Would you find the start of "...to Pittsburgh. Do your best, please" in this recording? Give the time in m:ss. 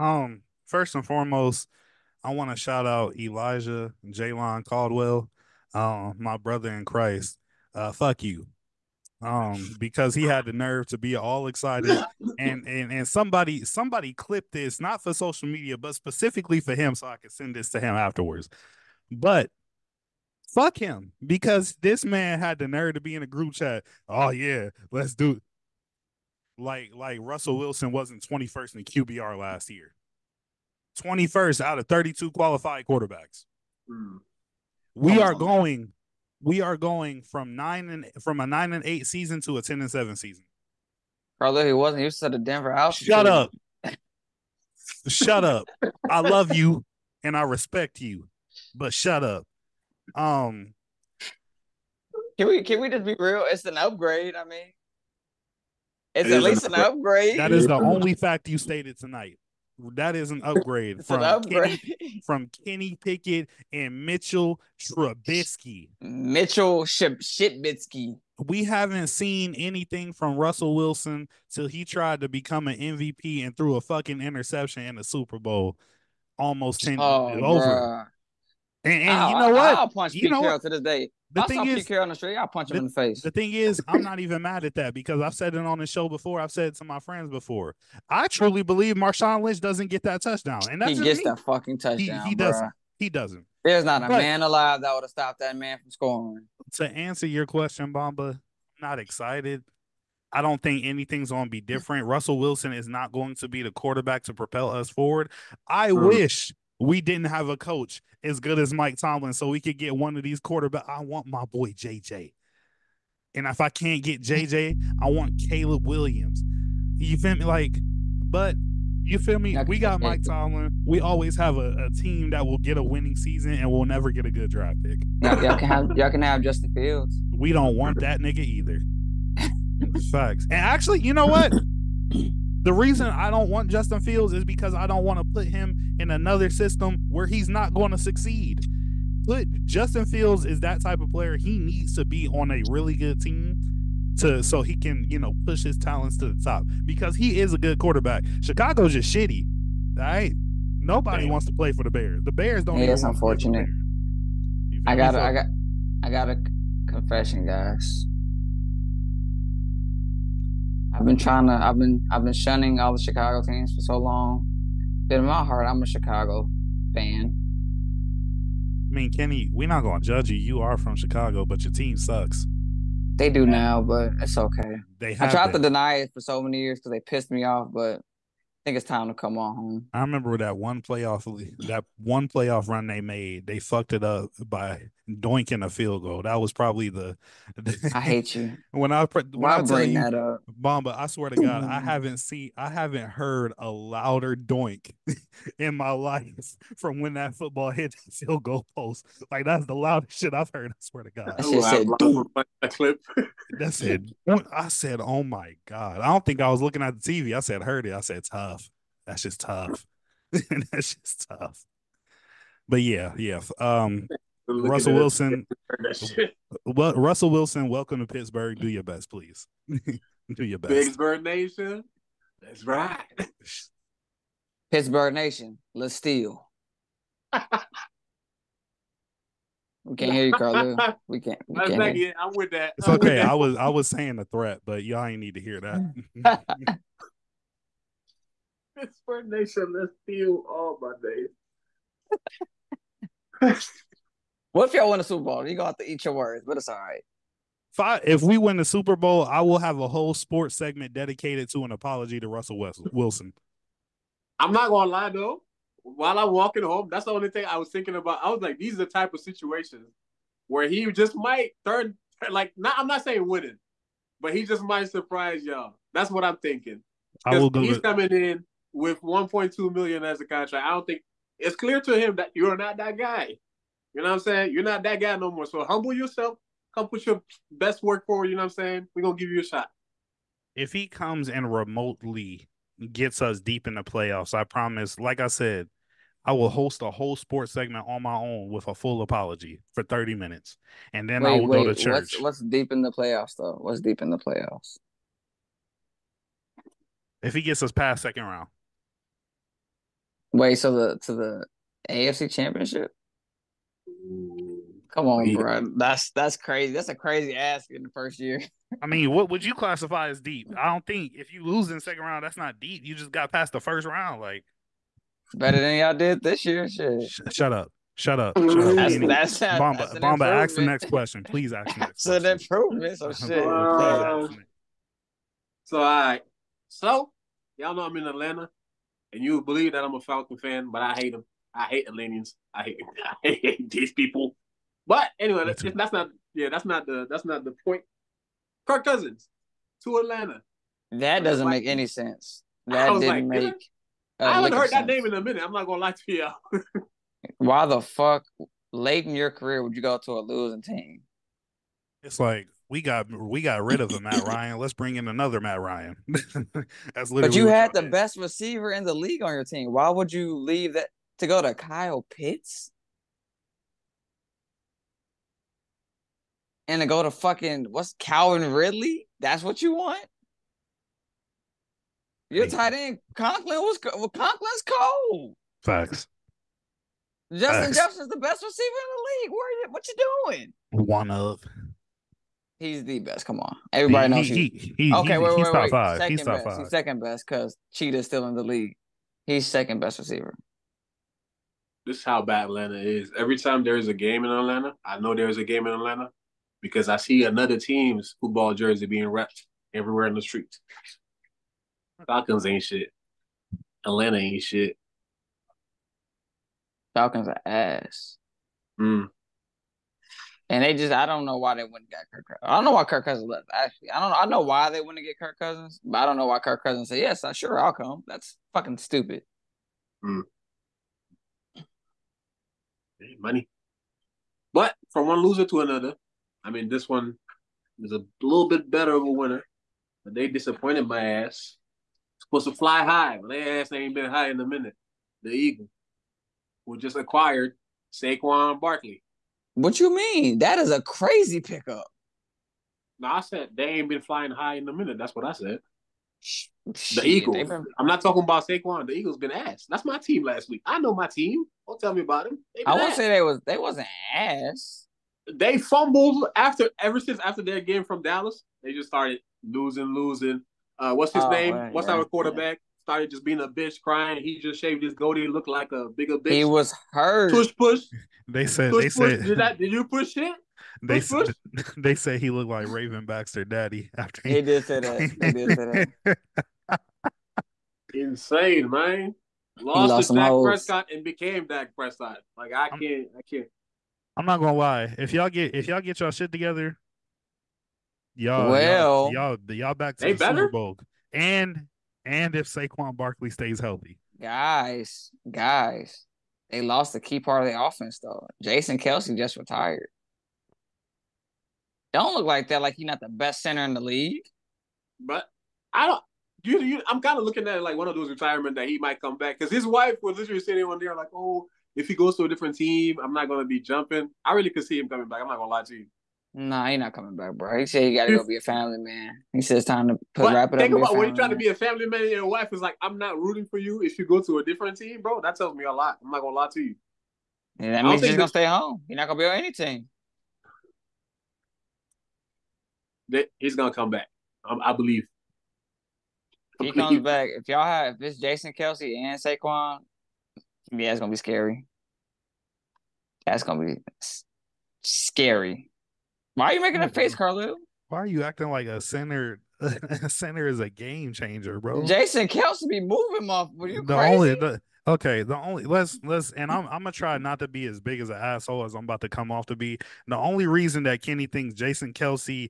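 3:38.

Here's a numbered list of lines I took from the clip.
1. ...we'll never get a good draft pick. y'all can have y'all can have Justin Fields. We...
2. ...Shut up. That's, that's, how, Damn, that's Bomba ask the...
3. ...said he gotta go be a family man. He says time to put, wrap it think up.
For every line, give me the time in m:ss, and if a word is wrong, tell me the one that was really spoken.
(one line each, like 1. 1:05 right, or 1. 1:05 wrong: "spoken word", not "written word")
1. 2:03 right
2. 5:18 wrong: "Bomba", not "Damn"
3. 8:37 right.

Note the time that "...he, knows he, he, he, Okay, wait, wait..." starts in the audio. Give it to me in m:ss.
6:24.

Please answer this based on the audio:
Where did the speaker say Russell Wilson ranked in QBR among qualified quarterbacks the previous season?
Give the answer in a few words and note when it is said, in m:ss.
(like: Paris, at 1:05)
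21st, at 0:31.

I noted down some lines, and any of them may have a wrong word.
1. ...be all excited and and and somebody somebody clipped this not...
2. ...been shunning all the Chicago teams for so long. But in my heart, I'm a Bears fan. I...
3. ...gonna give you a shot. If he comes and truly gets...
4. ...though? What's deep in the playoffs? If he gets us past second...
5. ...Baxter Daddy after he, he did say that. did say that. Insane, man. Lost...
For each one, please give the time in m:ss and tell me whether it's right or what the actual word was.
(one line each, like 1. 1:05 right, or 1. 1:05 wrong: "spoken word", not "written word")
1. 0:10 right
2. 2:42 wrong: "Chicago", not "Bears"
3. 4:39 wrong: "remotely", not "truly"
4. 4:53 right
5. 7:53 right.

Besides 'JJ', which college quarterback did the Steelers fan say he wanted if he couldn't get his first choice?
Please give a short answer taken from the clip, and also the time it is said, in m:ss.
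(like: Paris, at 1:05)
Caleb Williams, at 1:55.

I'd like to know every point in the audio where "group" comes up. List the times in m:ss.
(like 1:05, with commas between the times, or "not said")
0:23.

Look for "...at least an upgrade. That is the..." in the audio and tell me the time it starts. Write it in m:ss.
0:56.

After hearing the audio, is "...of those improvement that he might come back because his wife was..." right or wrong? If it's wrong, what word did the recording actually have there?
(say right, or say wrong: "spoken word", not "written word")
wrong: "retirement", not "improvement".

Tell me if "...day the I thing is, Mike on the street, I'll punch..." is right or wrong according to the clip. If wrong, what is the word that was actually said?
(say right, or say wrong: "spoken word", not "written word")
wrong: "Pete", not "Mike".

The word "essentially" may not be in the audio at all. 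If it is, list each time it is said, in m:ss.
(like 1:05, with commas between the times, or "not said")
not said.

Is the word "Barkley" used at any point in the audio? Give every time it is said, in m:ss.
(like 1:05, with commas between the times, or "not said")
7:18, 8:12.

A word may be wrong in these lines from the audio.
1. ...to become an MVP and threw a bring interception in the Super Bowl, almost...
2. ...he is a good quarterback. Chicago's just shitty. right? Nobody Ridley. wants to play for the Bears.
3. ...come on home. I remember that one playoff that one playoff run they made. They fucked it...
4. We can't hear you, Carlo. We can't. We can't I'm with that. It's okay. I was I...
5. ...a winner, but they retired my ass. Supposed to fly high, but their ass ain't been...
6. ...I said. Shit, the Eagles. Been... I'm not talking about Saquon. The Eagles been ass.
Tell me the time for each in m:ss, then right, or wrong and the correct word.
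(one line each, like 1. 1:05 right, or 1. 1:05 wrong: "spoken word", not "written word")
1. 1:12 wrong: "fucking", not "bring"
2. 2:27 wrong: "Damn", not "Ridley"
3. 2:59 right
4. 3:49 right
5. 7:09 wrong: "disappointed", not "retired"
6. 7:25 right.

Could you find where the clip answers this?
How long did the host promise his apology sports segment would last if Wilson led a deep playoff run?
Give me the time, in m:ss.
4:49.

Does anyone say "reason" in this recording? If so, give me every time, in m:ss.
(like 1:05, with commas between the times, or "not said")
2:12, 9:20.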